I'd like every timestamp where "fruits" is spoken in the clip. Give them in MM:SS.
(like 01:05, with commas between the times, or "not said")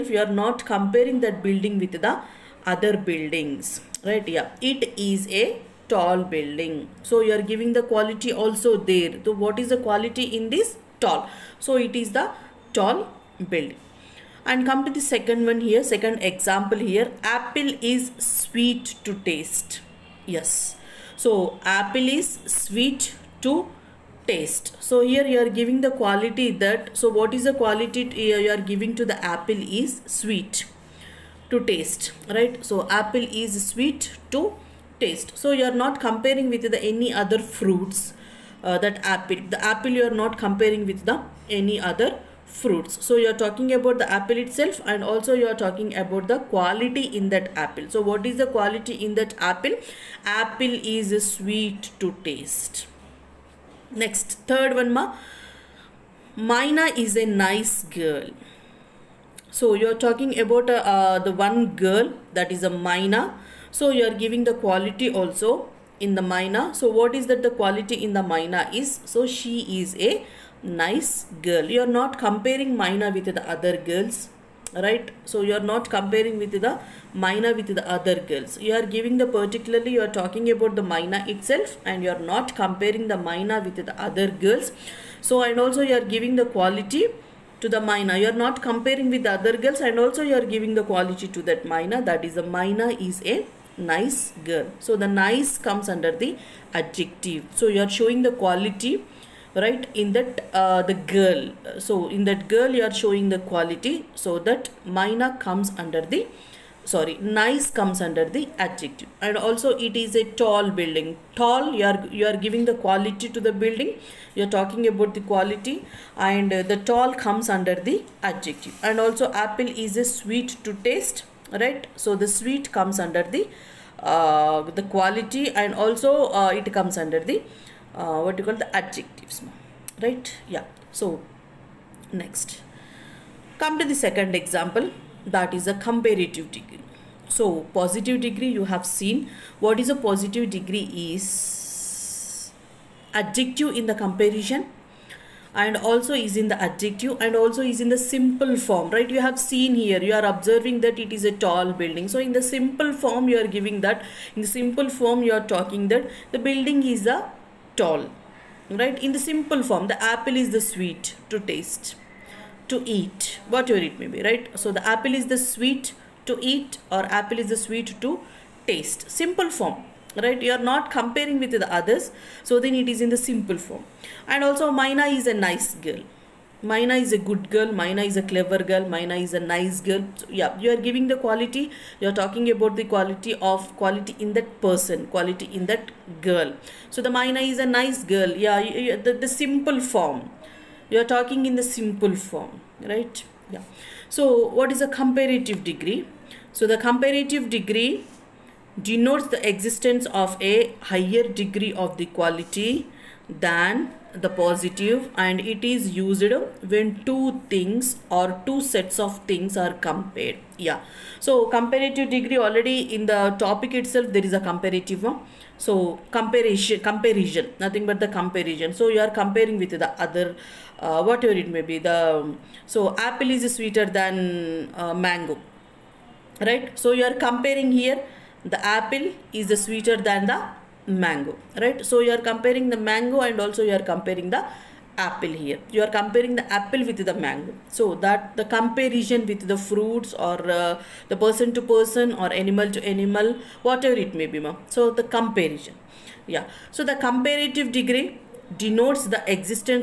00:37, 00:42, 03:59.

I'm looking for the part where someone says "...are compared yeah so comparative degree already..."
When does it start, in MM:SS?
03:29.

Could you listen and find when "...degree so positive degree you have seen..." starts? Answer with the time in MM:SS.
02:16.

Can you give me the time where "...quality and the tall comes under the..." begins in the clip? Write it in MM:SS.
01:55.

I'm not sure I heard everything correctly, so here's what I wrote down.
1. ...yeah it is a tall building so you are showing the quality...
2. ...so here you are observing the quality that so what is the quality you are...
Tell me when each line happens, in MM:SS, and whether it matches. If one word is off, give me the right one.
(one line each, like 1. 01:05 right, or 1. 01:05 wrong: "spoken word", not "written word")
1. 00:04 wrong: "giving", not "showing"
2. 00:24 wrong: "giving", not "observing".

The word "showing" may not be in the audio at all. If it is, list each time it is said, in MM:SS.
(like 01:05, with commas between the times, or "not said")
01:37, 01:42.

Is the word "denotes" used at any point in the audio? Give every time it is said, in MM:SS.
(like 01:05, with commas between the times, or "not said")
03:18, 04:08.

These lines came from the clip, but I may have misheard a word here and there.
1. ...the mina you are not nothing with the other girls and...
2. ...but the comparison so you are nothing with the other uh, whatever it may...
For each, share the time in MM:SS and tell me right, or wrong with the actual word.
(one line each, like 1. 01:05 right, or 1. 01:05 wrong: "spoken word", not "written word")
1. 01:27 wrong: "comparing", not "nothing"
2. 03:37 wrong: "comparing", not "nothing".